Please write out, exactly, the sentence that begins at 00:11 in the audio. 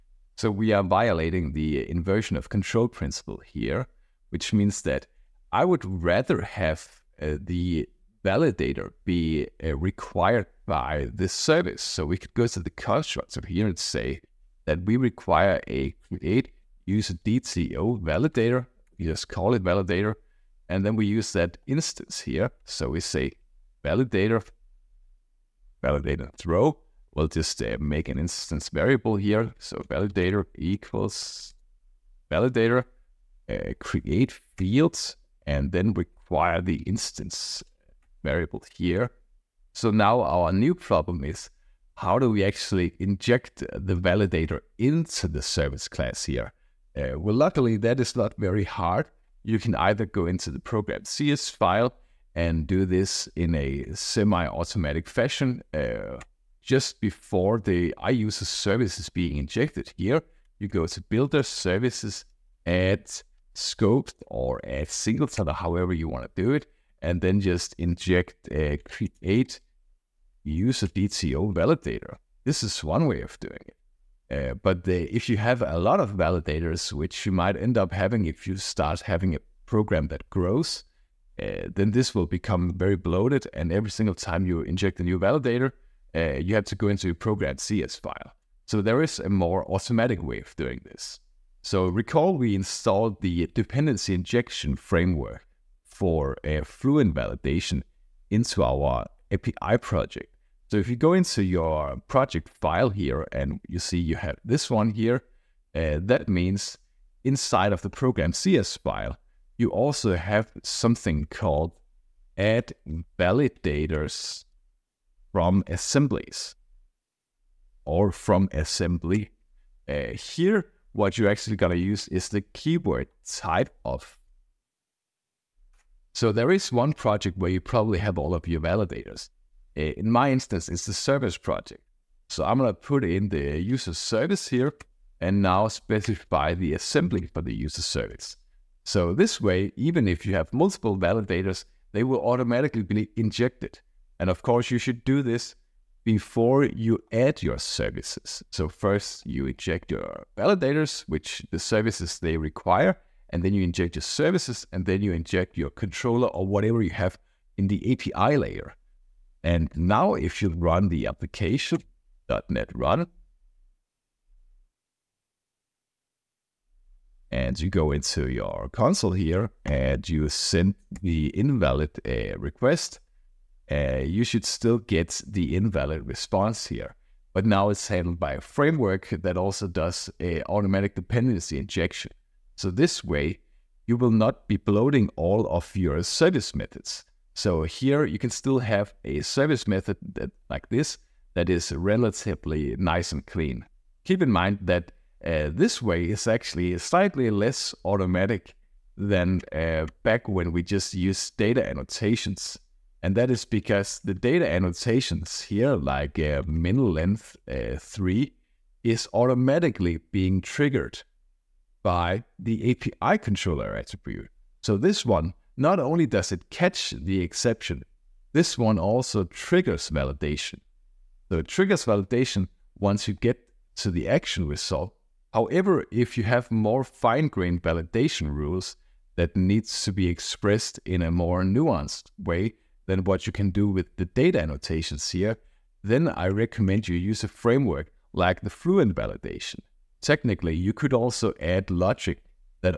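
So we could go to the constructor here and say that we require a create use DTO validator.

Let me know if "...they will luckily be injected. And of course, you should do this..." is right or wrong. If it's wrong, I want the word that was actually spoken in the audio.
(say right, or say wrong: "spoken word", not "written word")
wrong: "automatically", not "luckily".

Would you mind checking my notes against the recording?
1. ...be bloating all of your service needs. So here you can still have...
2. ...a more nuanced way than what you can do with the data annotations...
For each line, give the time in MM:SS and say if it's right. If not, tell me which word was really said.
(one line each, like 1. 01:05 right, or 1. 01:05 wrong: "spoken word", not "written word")
1. 03:04 wrong: "methods", not "needs"
2. 03:51 right.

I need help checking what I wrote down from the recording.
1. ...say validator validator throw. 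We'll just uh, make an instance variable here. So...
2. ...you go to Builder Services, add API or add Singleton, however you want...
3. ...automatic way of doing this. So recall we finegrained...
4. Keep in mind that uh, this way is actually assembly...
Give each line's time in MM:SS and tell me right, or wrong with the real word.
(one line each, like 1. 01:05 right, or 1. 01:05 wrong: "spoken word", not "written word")
1. 00:23 right
2. 01:00 wrong: "Scoped", not "API"
3. 01:29 wrong: "installed", not "finegrained"
4. 03:14 wrong: "slightly", not "assembly".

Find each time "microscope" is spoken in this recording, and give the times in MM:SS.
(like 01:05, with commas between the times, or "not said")
not said.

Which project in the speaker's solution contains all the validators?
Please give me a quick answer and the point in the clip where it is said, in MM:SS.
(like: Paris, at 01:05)
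the service project, at 02:10.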